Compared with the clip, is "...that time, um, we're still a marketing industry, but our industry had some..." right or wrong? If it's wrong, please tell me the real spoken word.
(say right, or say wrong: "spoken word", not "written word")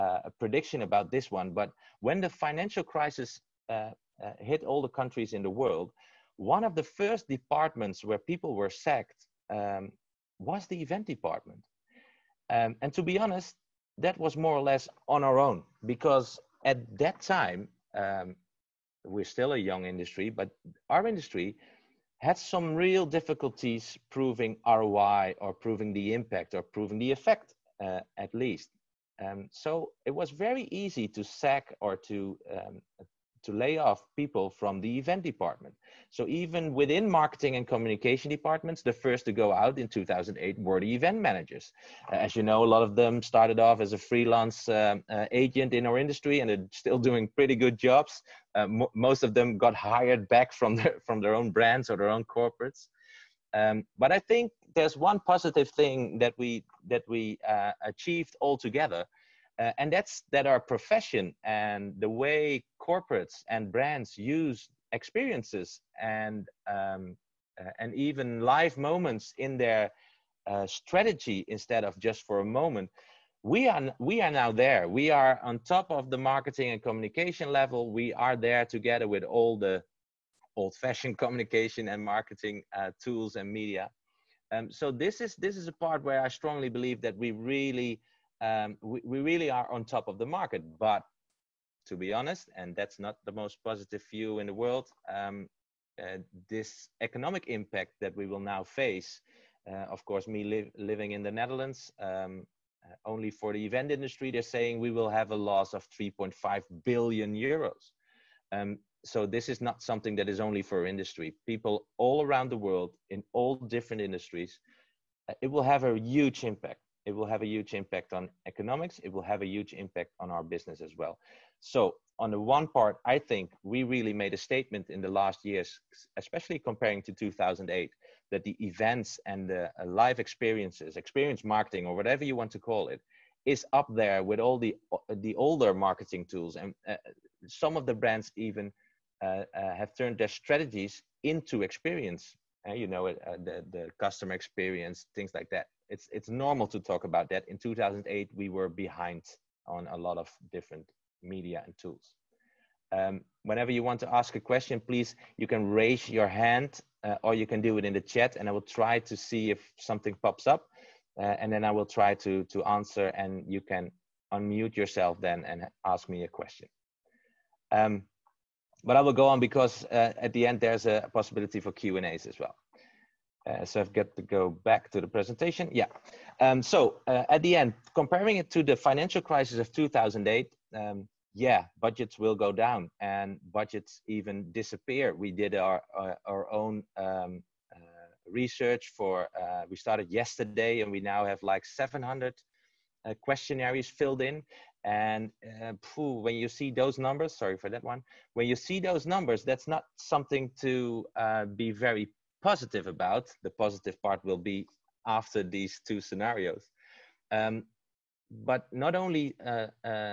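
wrong: "young", not "marketing".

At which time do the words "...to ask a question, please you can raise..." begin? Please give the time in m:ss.
2:34.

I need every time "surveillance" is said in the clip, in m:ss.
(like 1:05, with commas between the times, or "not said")
not said.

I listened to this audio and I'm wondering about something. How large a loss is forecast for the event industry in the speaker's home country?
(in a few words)
3.5 billion euros.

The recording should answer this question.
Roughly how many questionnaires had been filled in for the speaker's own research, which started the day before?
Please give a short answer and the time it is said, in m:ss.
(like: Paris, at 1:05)
700, at 3:11.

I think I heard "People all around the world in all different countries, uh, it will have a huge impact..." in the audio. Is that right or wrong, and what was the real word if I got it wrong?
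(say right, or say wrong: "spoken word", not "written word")
wrong: "industries", not "countries".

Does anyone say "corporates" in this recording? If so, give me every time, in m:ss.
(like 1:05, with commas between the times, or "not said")
0:52, 1:02.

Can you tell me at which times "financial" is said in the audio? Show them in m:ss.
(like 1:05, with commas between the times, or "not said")
0:02, 2:58.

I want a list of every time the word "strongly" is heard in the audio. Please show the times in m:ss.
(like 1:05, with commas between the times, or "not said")
1:26.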